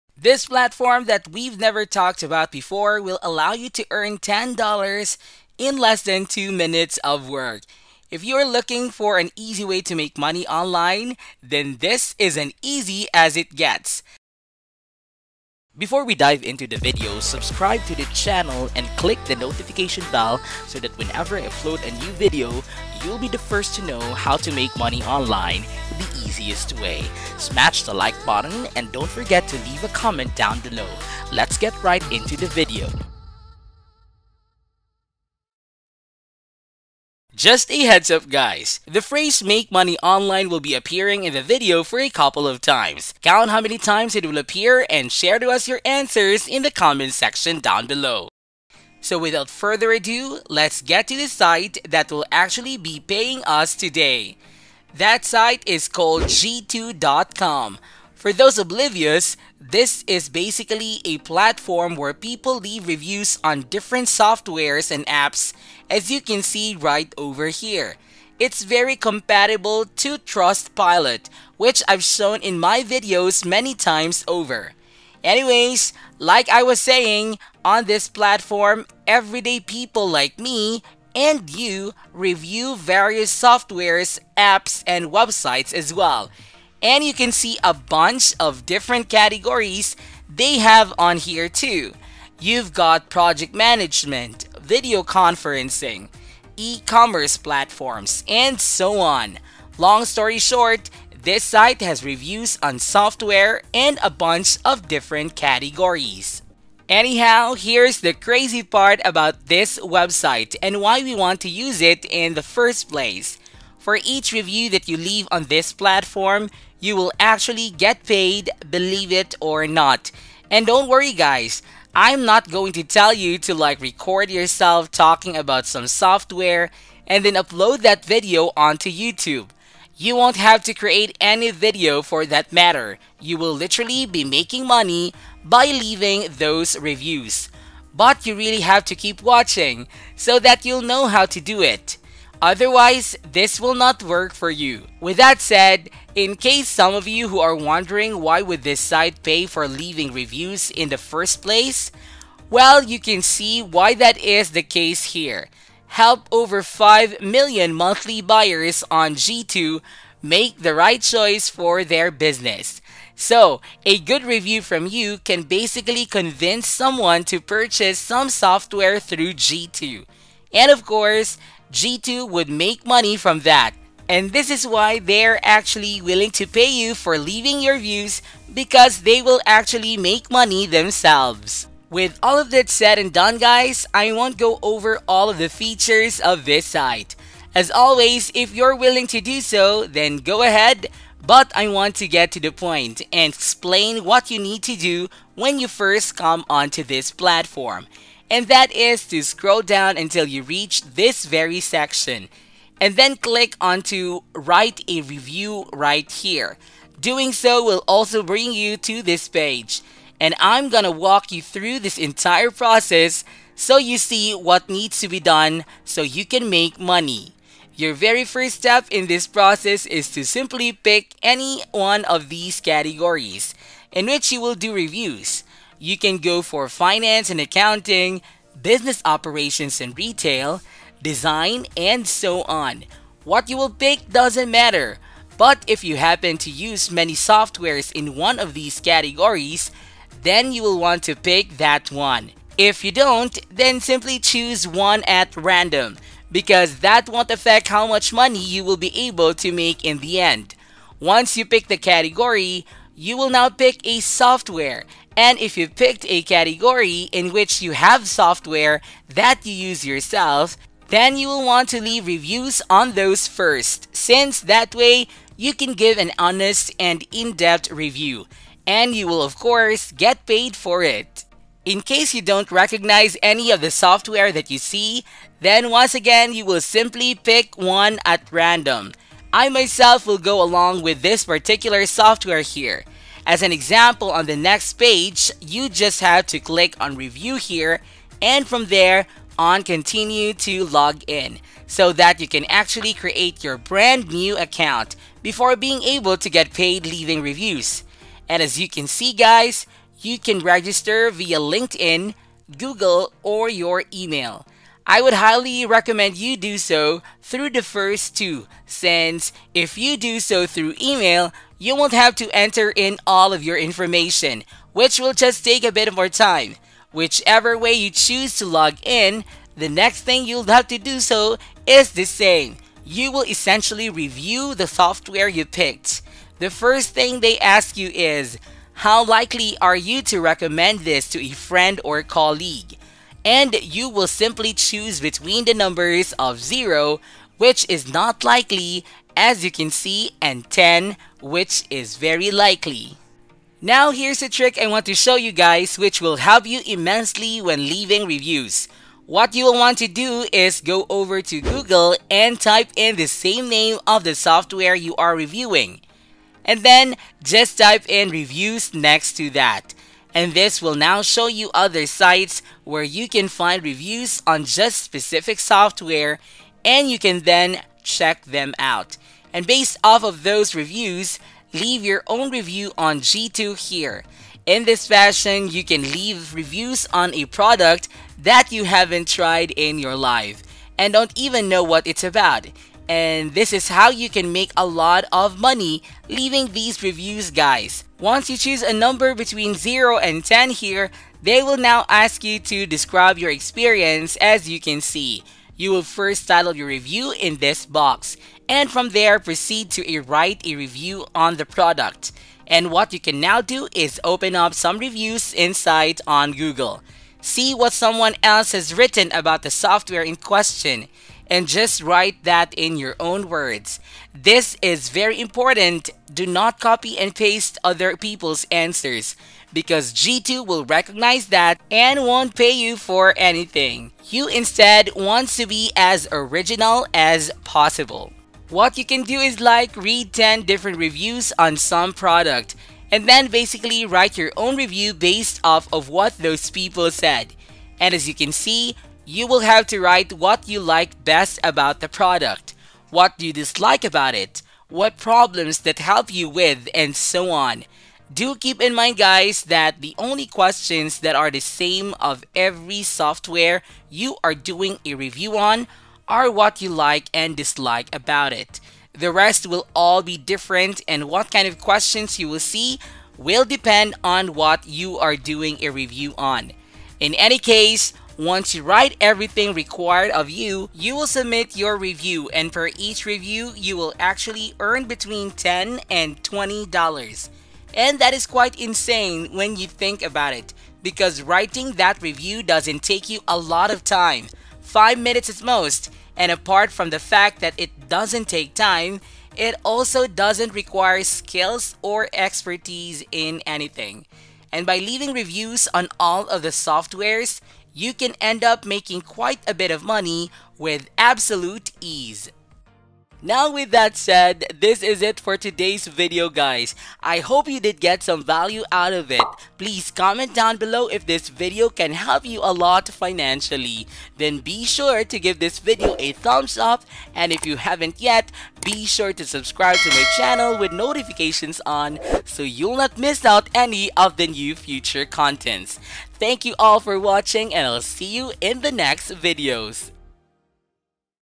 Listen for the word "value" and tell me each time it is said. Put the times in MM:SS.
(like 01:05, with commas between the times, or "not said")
08:28.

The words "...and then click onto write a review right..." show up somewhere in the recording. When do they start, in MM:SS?
03:22.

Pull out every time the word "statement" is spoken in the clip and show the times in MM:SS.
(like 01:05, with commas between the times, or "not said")
not said.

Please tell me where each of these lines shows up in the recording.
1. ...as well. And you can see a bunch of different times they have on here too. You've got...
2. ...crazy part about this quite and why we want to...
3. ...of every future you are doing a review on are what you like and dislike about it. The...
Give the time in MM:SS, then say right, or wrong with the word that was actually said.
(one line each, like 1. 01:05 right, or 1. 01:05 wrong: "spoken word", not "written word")
1. 01:25 wrong: "categories", not "times"
2. 01:48 wrong: "website", not "quite"
3. 07:31 wrong: "software", not "future".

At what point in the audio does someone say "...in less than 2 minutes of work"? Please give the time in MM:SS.
00:05.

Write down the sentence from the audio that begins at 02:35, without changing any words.
Help over 5 million monthly buyers on G2 make the right choice for their business.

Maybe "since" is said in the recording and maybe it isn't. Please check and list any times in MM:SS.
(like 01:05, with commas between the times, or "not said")
04:23, 05:08.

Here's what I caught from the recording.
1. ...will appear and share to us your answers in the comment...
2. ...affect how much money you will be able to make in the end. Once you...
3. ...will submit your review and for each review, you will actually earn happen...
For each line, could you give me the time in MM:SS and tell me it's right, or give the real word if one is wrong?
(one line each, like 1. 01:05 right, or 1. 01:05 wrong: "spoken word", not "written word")
1. 00:44 right
2. 04:07 right
3. 07:50 wrong: "between", not "happen".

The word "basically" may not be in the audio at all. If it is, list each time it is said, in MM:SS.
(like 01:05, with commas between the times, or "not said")
01:00, 02:45, 07:13.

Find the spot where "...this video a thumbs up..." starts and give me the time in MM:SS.
08:35.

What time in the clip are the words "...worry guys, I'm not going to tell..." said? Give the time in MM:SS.
02:00.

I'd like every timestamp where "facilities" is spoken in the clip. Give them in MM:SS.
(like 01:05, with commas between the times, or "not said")
not said.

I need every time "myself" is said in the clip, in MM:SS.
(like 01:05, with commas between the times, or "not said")
04:39.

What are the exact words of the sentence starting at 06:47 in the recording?
See what someone else has written about the software in question and just write that in your own words.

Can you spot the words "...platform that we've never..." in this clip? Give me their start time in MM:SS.
00:00.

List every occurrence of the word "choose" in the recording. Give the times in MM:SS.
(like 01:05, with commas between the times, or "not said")
04:04, 05:17, 05:34, 06:28.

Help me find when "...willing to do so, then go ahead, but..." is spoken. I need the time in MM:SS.
03:08.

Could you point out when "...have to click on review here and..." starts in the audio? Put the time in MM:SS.
04:46.